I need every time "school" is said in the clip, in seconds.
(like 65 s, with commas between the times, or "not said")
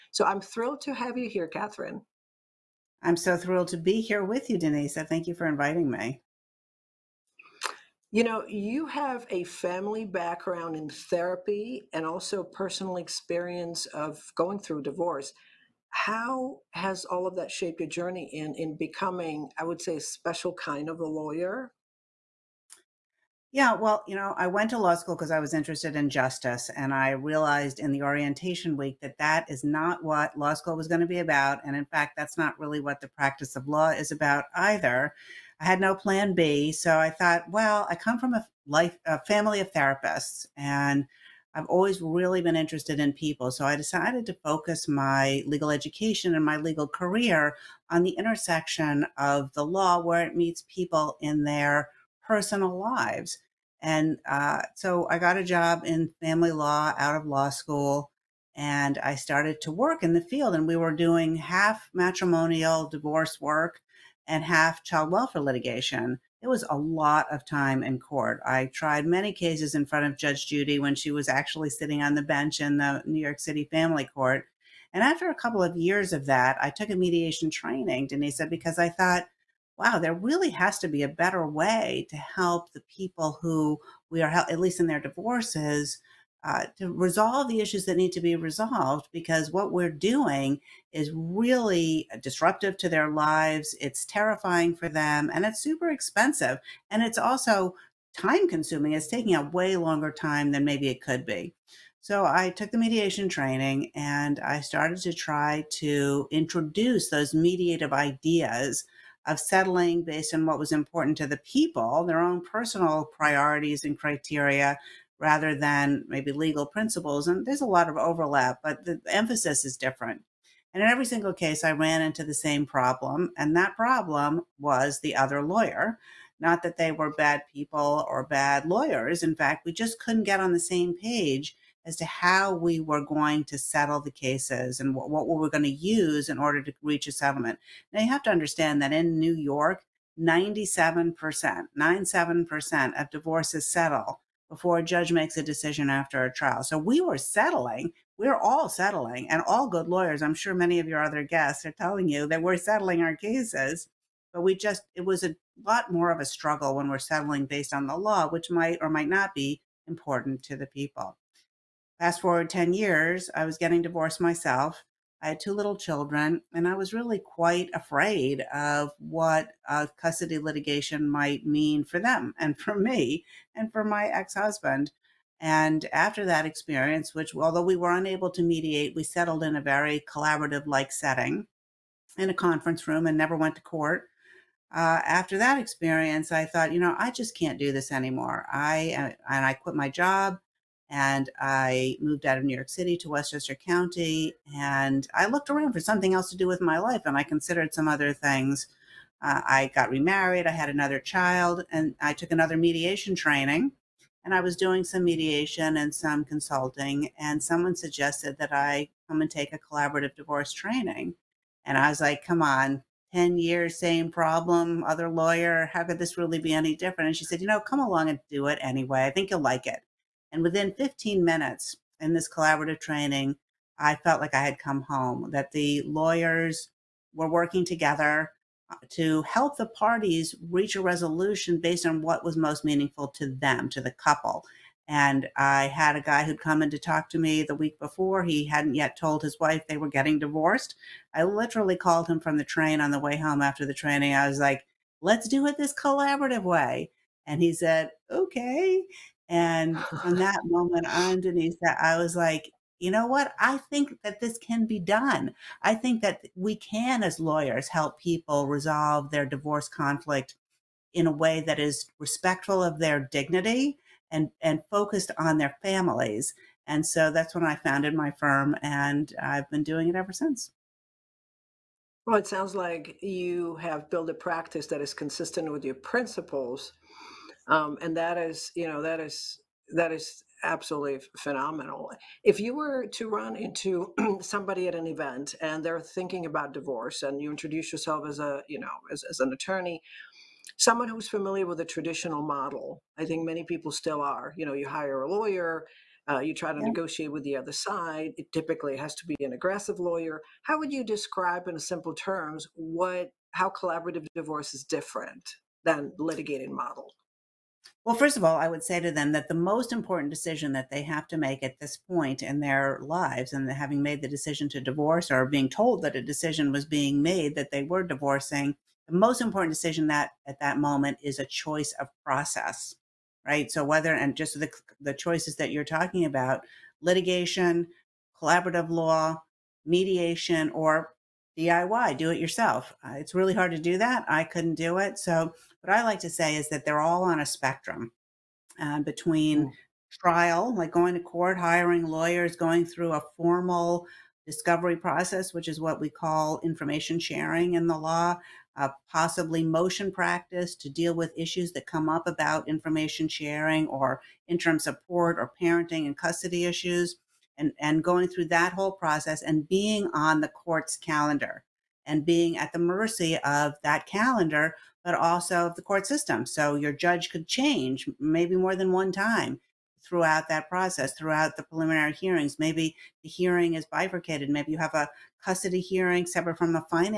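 24 s, 30 s, 57 s.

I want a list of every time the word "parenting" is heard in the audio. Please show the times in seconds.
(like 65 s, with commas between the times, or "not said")
355 s.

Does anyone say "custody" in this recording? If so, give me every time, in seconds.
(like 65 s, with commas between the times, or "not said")
169 s, 355 s, 375 s.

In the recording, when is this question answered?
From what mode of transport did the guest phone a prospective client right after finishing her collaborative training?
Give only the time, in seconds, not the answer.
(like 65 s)
242 s.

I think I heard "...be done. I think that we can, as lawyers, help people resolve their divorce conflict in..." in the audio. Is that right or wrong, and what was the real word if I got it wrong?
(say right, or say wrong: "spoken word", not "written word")
right.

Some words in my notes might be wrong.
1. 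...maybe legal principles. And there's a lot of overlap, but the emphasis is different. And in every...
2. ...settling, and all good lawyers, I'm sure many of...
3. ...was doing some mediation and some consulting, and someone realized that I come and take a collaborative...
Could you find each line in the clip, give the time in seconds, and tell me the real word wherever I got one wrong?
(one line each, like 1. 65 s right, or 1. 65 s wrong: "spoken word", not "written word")
1. 116 s right
2. 148 s right
3. 204 s wrong: "suggested", not "realized".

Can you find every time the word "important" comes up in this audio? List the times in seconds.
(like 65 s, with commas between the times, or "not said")
110 s, 159 s, 309 s, 319 s.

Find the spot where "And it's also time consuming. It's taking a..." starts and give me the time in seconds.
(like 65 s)
96 s.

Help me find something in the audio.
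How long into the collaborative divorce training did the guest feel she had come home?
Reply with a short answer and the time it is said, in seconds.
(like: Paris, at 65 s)
15 minutes, at 220 s.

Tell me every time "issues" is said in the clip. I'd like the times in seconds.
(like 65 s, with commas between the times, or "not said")
87 s, 351 s, 356 s.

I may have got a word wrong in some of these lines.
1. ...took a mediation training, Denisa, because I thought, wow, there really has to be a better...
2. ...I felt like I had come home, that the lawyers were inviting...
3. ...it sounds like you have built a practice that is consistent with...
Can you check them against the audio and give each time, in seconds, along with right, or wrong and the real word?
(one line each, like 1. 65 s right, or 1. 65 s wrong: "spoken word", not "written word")
1. 76 s right
2. 223 s wrong: "working", not "inviting"
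3. 272 s right.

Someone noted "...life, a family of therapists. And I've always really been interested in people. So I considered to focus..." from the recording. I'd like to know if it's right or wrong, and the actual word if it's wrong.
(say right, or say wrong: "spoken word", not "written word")
wrong: "decided", not "considered".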